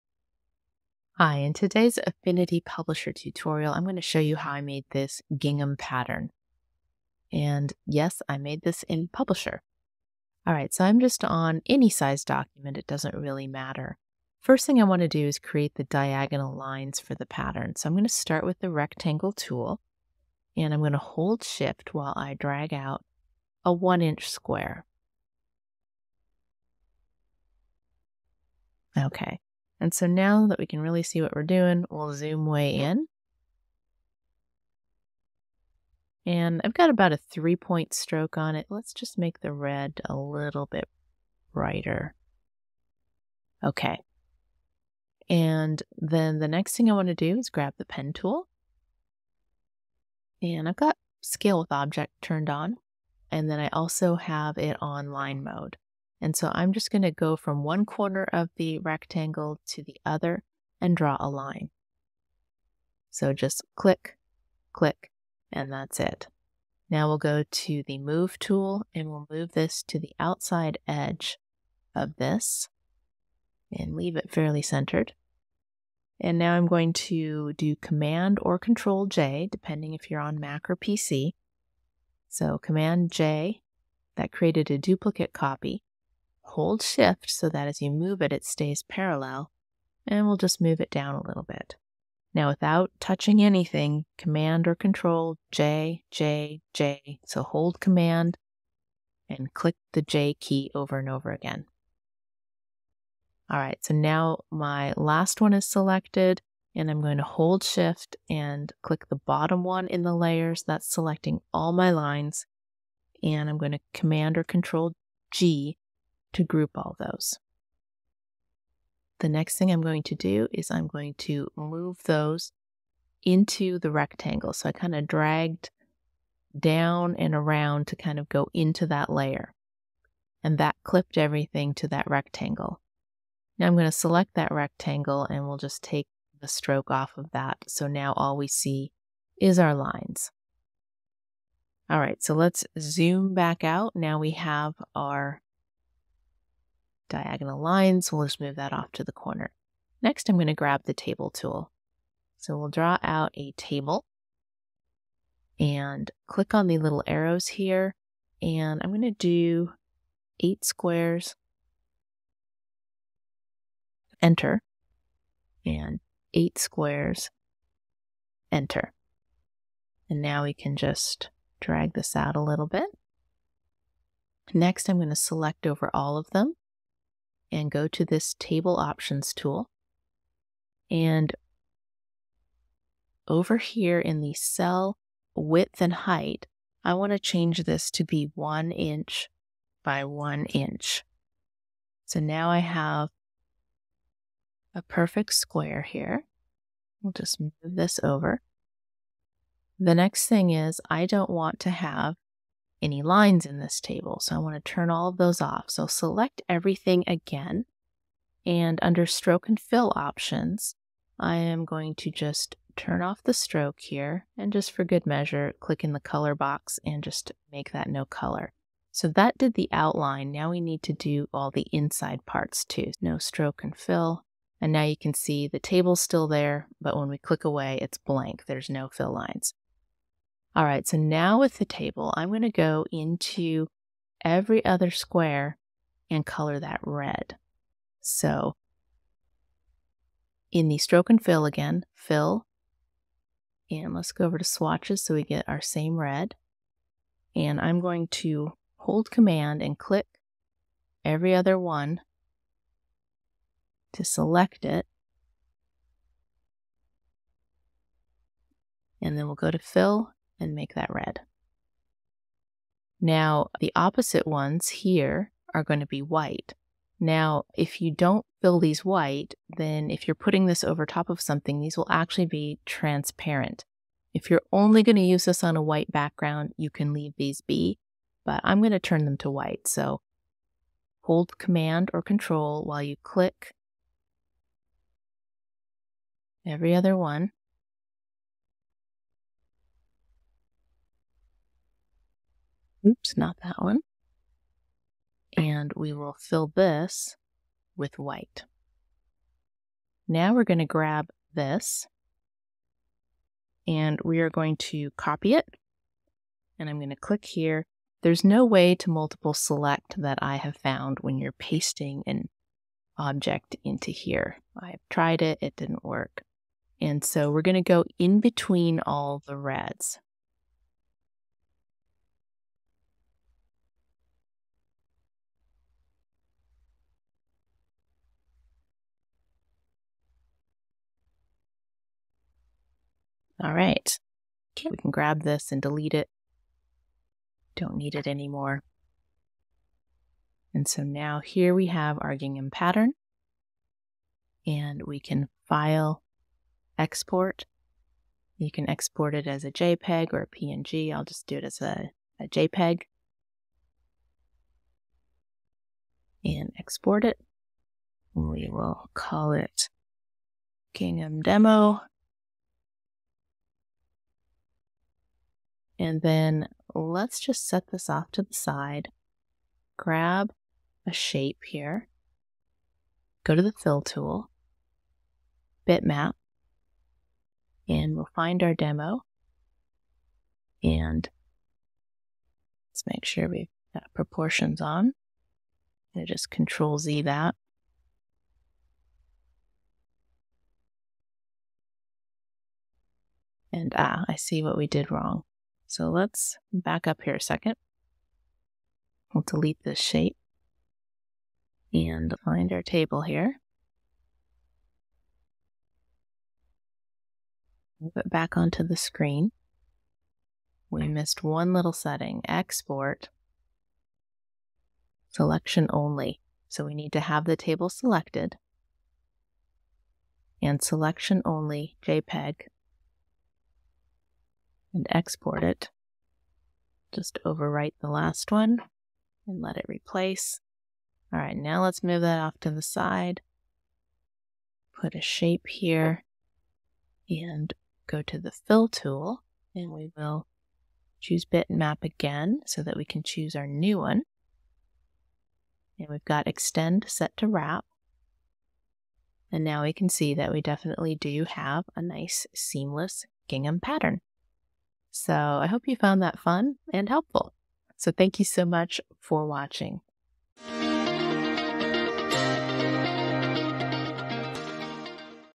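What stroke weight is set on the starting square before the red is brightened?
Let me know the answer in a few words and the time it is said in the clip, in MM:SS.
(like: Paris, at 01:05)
3 point, at 00:37.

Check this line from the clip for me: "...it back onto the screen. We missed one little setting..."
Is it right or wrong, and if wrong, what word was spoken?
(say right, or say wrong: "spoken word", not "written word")
right.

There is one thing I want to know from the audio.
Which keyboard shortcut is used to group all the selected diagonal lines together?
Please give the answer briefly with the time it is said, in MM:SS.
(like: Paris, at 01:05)
Command or Control G, at 01:53.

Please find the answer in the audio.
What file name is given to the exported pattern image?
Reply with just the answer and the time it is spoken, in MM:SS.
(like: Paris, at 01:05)
Gingham Demo, at 06:00.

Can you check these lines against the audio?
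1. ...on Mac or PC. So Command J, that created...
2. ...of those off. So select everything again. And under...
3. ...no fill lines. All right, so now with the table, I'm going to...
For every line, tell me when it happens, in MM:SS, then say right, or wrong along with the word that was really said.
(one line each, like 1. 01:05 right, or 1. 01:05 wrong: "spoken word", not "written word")
1. 01:20 right
2. 03:25 right
3. 03:48 right.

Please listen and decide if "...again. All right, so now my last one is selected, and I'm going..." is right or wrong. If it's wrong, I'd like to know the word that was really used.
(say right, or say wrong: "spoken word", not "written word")
right.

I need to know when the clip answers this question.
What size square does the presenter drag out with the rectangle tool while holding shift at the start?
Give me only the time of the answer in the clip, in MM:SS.
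00:23.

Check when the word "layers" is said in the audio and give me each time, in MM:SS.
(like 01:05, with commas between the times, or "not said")
01:50, 02:09.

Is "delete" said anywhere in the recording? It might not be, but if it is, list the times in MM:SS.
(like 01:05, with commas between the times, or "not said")
05:35, 06:39.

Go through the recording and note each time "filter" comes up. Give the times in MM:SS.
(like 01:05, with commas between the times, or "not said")
not said.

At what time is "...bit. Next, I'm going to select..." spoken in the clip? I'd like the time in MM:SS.
02:52.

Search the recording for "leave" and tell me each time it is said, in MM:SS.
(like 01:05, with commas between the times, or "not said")
01:13, 04:36.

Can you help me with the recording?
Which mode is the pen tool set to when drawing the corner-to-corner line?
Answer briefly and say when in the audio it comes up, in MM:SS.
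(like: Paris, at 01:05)
line mode, at 00:55.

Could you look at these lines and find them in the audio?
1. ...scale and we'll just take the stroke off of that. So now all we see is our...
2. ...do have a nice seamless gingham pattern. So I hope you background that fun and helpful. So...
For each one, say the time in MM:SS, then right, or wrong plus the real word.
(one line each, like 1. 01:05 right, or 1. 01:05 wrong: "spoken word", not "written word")
1. 02:14 wrong: "rectangle", not "scale"
2. 07:30 wrong: "found", not "background".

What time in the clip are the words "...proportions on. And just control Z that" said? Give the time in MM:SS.
06:23.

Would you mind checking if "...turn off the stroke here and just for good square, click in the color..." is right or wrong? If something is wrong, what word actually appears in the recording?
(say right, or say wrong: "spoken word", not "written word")
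wrong: "measure", not "square".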